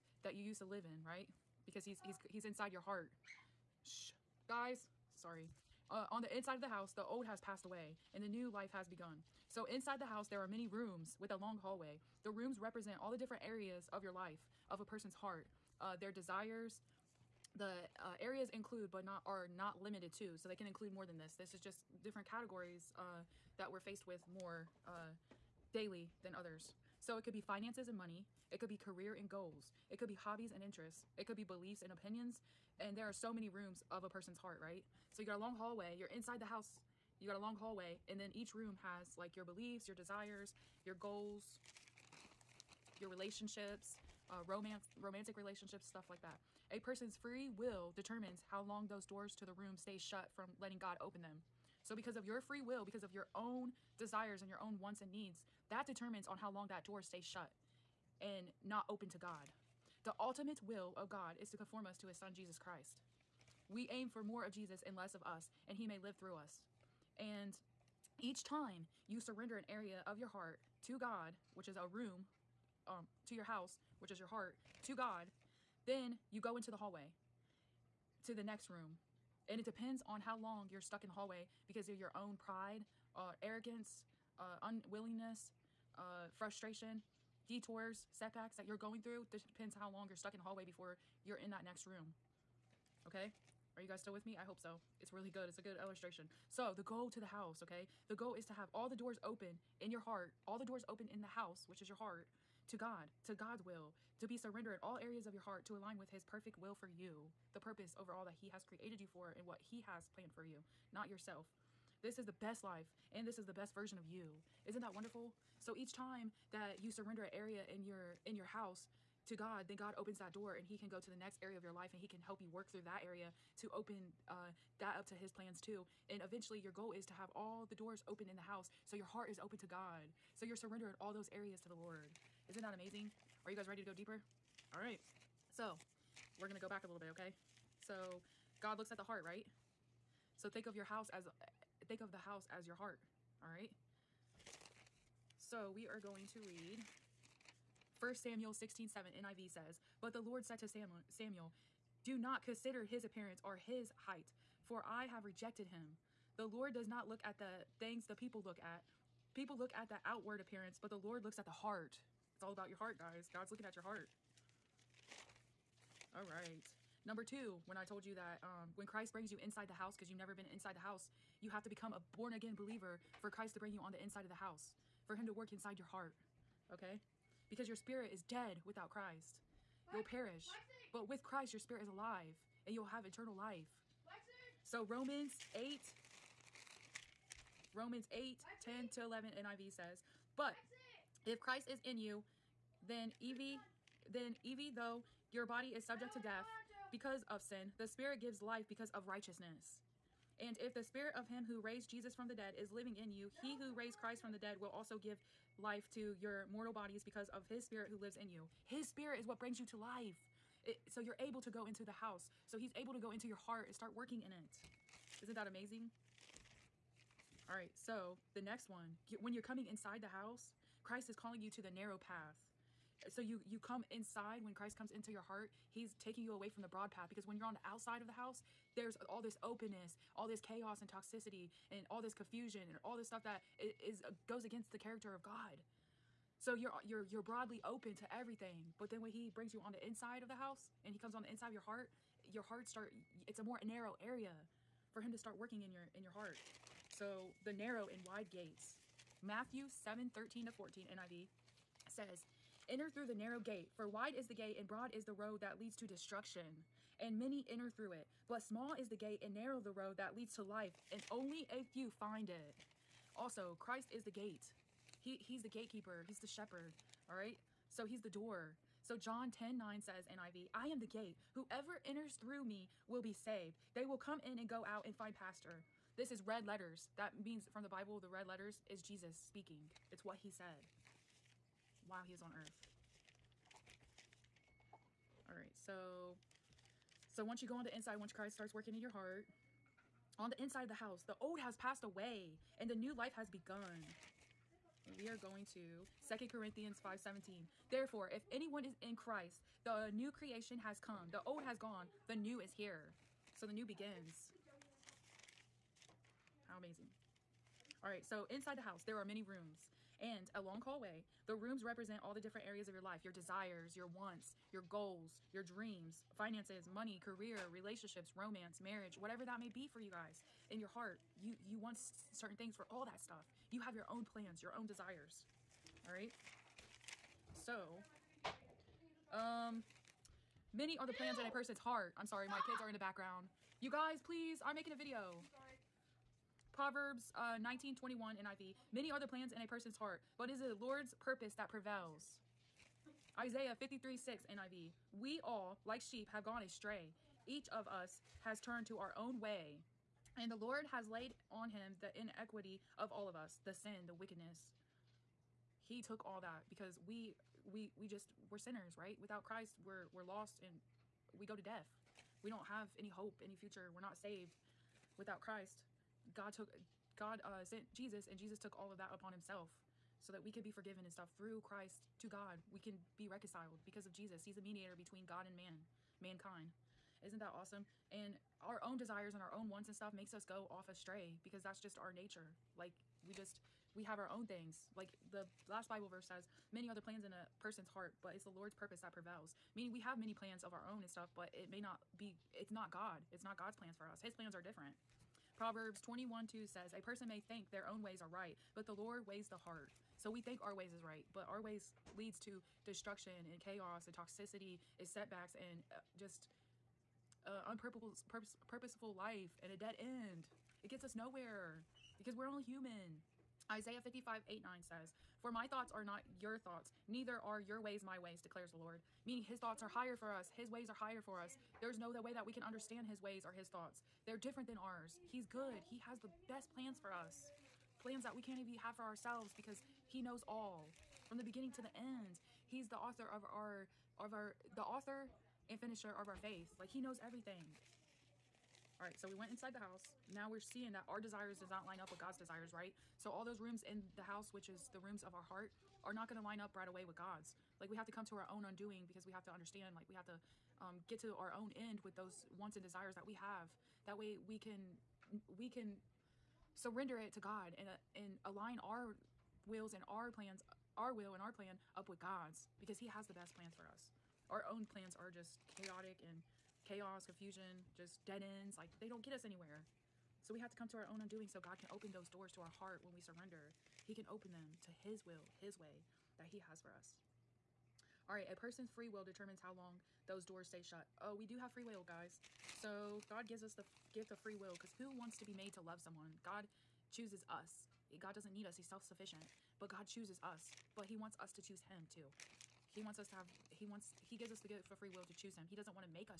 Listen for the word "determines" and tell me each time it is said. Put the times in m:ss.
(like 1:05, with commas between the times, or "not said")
0:47, 0:55, 7:59.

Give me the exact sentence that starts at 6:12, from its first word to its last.
We can be reconciled because of Jesus.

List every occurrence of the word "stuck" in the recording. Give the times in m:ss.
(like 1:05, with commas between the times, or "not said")
1:20, 1:30.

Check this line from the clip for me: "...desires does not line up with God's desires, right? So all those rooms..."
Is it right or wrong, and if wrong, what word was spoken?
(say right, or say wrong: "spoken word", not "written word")
right.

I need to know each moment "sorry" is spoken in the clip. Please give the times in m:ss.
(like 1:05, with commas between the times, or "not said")
0:05, 5:32.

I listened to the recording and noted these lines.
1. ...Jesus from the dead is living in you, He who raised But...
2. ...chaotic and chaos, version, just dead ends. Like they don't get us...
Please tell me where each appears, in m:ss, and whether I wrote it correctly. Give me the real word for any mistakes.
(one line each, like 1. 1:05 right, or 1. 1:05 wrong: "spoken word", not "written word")
1. 3:21 wrong: "Christ", not "But"
2. 7:45 wrong: "confusion", not "version".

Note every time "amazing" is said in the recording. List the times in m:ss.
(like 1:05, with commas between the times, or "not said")
2:12, 3:35, 5:06.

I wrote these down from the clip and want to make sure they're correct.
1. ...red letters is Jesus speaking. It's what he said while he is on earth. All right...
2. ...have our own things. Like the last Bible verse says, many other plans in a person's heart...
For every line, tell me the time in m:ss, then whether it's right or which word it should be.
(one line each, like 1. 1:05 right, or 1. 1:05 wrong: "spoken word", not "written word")
1. 4:38 right
2. 6:23 right.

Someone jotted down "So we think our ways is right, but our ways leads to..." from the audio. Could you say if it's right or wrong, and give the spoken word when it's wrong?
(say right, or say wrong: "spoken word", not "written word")
right.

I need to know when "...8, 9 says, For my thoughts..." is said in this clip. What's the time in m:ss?
6:54.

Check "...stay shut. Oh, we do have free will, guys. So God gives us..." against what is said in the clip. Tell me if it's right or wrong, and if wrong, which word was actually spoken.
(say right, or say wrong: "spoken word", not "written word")
right.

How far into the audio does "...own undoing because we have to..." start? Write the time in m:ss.
7:28.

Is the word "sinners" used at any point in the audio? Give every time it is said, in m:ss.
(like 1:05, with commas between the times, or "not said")
5:58.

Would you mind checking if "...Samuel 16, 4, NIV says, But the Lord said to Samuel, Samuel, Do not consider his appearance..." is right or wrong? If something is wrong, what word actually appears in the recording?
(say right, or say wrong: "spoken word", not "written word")
wrong: "7", not "4".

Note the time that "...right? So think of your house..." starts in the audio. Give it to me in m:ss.
2:19.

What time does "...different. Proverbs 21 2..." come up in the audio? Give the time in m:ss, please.
6:34.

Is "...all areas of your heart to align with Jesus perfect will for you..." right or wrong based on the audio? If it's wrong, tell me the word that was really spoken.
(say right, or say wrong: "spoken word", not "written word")
wrong: "His", not "Jesus".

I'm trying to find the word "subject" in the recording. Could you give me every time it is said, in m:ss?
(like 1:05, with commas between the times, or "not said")
3:15.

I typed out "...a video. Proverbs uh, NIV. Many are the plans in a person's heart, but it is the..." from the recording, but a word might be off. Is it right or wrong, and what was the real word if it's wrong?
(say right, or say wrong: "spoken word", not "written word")
right.